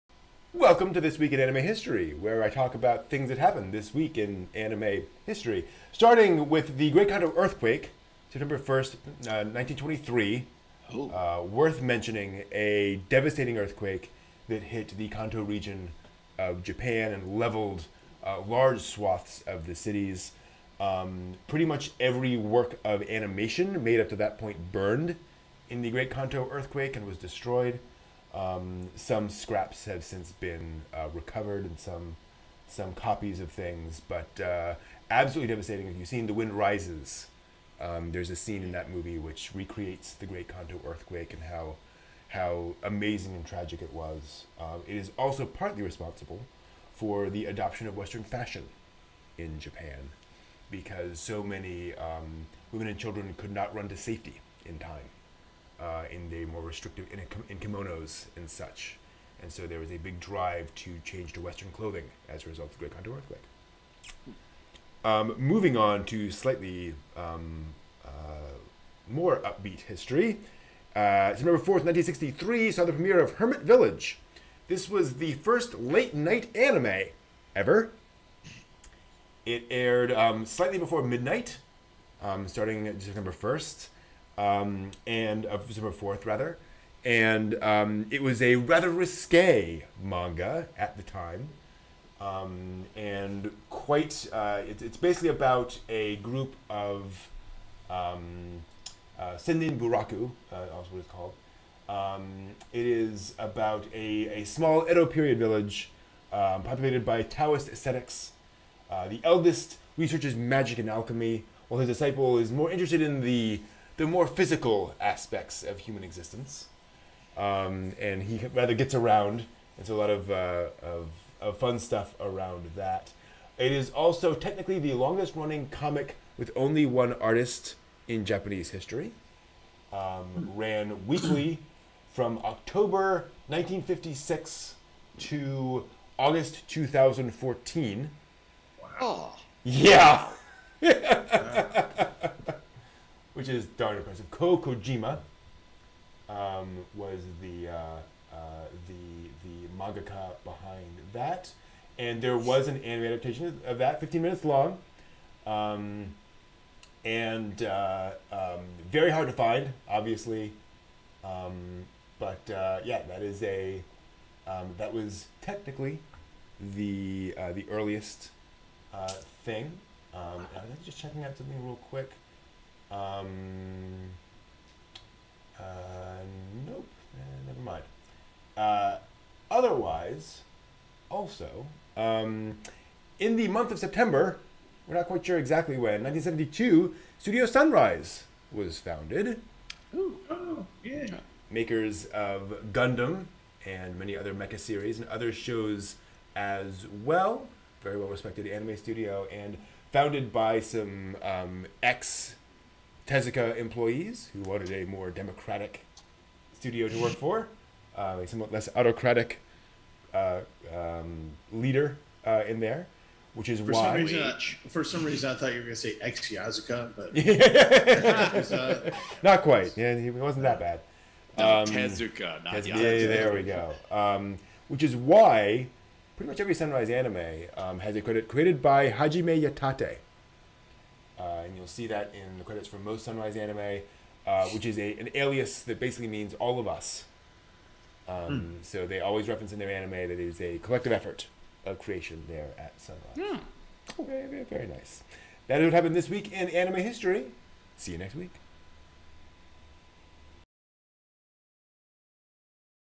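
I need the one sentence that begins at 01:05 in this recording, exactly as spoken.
Um, moving on to slightly um, uh, more upbeat history.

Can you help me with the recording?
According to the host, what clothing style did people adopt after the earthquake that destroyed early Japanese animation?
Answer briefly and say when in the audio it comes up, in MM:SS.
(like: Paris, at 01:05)
Western clothing, at 01:01.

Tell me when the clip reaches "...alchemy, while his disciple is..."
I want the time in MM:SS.
01:50.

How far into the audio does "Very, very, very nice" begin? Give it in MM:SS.
04:04.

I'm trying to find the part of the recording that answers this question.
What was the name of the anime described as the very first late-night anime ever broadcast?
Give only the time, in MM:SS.
01:13.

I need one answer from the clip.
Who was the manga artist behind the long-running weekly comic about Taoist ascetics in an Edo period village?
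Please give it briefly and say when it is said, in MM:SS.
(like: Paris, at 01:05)
Ko Kojima, at 02:24.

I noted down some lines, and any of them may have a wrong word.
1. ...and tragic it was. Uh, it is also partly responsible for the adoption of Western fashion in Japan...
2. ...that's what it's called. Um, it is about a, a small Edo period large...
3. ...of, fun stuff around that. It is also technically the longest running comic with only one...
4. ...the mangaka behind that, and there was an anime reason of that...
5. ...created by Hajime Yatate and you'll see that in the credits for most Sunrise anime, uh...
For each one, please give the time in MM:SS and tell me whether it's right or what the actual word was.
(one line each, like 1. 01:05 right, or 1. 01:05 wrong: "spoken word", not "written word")
1. 00:43 right
2. 01:40 wrong: "village", not "large"
3. 02:01 right
4. 02:29 wrong: "adaptation", not "reason"
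5. 03:48 right.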